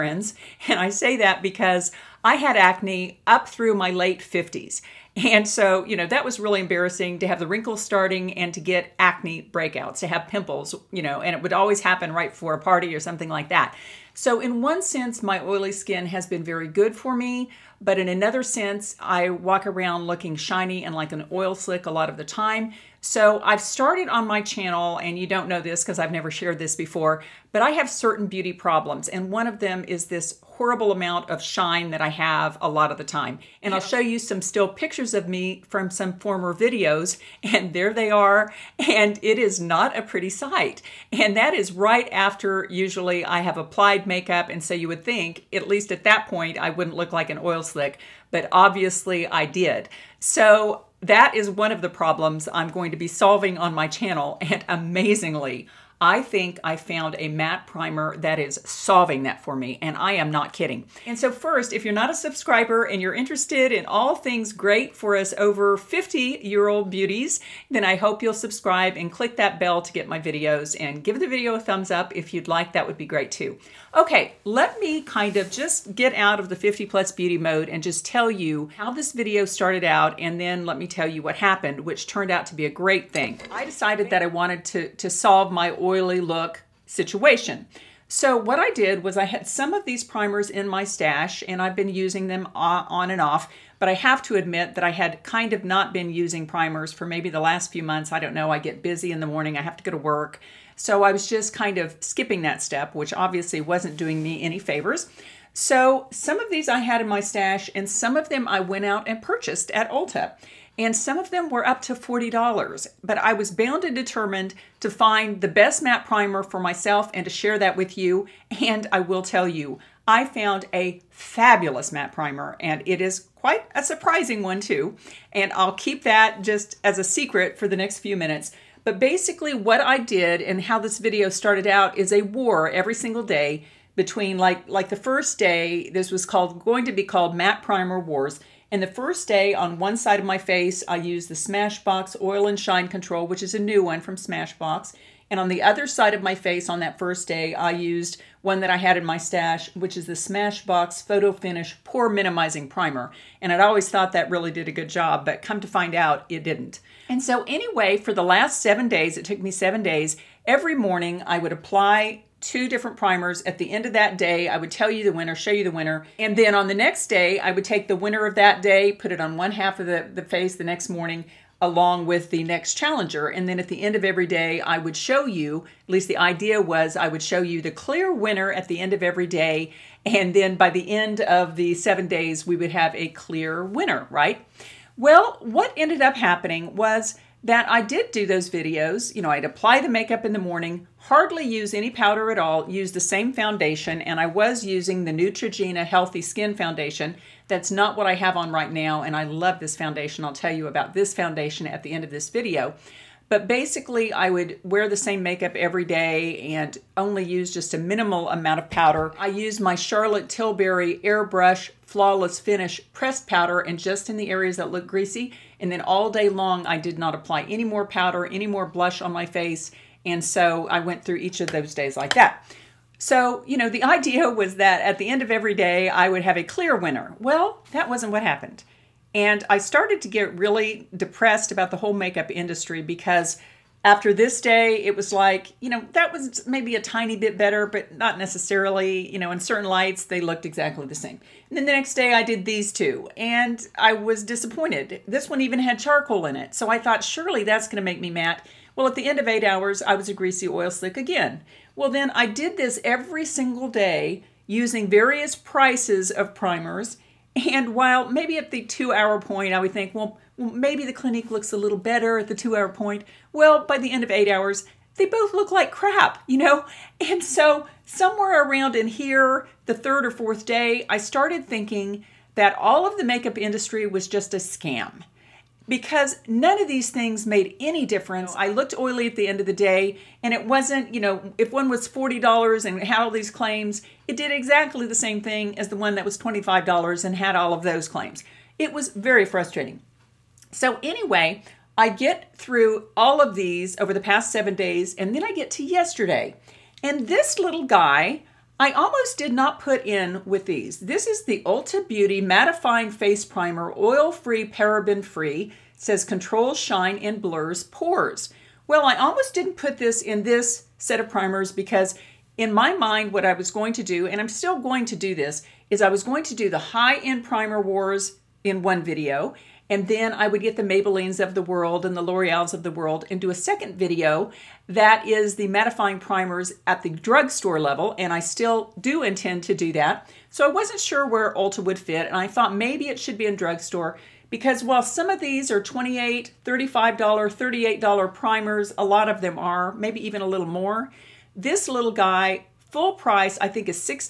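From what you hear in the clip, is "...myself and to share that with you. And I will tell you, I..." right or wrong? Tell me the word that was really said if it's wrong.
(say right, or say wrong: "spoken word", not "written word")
right.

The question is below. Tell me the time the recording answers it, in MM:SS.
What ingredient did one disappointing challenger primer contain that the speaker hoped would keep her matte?
04:05.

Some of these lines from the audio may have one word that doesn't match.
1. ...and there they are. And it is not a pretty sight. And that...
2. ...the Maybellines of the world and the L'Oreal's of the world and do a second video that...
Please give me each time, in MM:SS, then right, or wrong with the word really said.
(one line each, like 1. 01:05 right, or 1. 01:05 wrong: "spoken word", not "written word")
1. 00:37 right
2. 05:20 right.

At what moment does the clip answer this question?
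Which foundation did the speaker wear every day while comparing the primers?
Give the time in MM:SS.
03:15.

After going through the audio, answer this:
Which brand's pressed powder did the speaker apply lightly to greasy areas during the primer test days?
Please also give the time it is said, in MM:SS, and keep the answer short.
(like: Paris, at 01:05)
Charlotte Tilbury, at 03:29.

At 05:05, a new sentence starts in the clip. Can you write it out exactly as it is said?
says controls shine and blurs pores.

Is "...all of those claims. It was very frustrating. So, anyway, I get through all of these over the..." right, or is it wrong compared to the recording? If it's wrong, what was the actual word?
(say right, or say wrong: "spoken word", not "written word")
right.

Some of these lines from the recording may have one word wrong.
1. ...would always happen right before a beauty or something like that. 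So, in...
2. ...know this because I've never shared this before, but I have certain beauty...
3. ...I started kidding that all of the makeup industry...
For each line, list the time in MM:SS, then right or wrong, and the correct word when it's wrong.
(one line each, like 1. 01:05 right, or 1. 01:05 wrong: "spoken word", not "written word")
1. 00:11 wrong: "party", not "beauty"
2. 00:25 right
3. 04:30 wrong: "thinking", not "kidding".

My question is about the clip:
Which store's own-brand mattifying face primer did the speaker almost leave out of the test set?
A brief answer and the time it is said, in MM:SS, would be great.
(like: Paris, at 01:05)
Ulta Beauty, at 05:01.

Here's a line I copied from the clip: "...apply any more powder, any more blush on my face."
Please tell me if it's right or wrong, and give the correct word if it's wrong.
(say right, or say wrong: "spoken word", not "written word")
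right.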